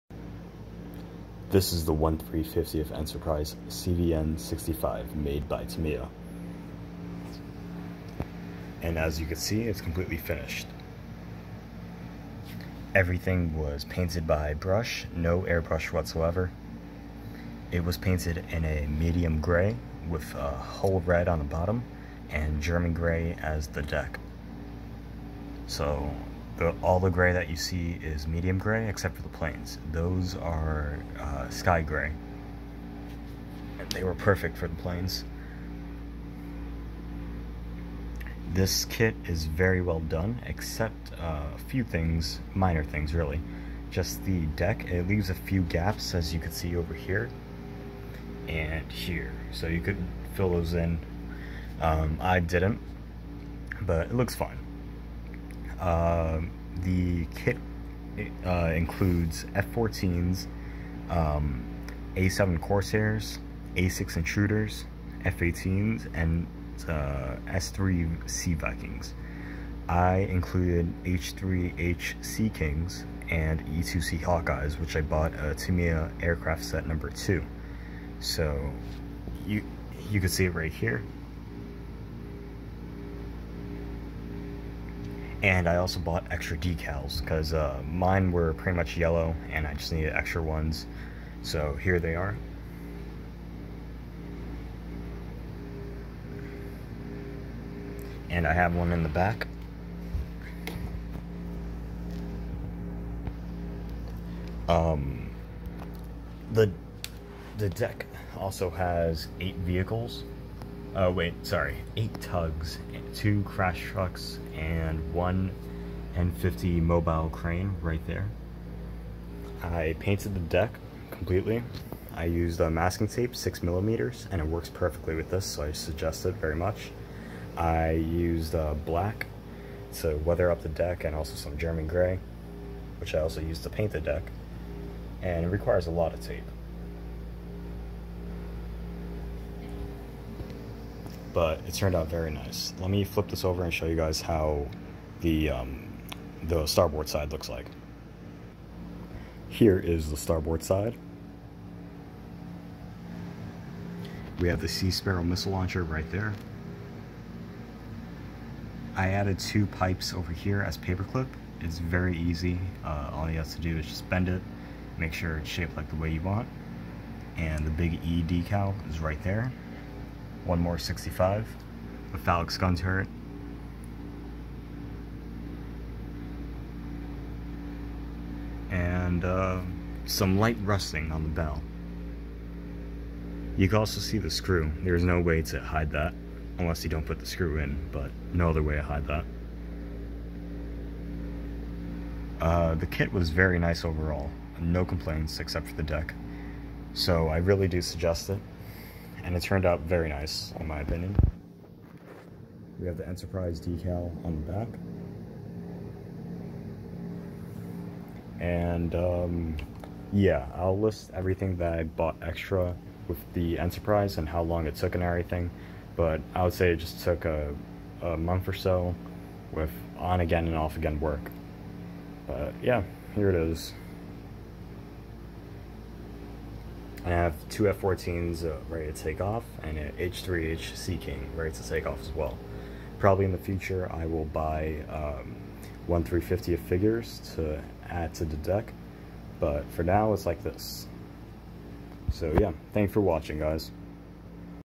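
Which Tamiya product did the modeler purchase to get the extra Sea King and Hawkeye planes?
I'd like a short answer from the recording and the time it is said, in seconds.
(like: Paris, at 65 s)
Tamiya aircraft set number 2, at 75 s.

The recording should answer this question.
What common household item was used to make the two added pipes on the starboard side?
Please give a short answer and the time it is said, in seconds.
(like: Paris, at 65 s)
Paperclip, at 160 s.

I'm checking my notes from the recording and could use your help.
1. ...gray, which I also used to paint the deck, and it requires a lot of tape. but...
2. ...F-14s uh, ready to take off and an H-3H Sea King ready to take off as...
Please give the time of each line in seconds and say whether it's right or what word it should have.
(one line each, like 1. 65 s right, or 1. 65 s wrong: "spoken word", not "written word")
1. 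131 s right
2. 227 s right.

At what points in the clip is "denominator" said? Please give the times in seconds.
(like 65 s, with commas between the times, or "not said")
not said.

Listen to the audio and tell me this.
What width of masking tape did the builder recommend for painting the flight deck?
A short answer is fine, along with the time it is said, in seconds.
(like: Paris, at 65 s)
6 millimeters, at 123 s.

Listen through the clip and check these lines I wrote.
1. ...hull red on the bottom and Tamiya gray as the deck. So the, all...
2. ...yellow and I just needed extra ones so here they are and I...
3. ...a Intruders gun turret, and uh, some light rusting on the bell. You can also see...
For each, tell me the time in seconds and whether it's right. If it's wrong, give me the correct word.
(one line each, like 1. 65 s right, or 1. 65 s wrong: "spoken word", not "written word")
1. 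20 s wrong: "German", not "Tamiya"
2. 88 s right
3. 172 s wrong: "Phalanx", not "Intruders".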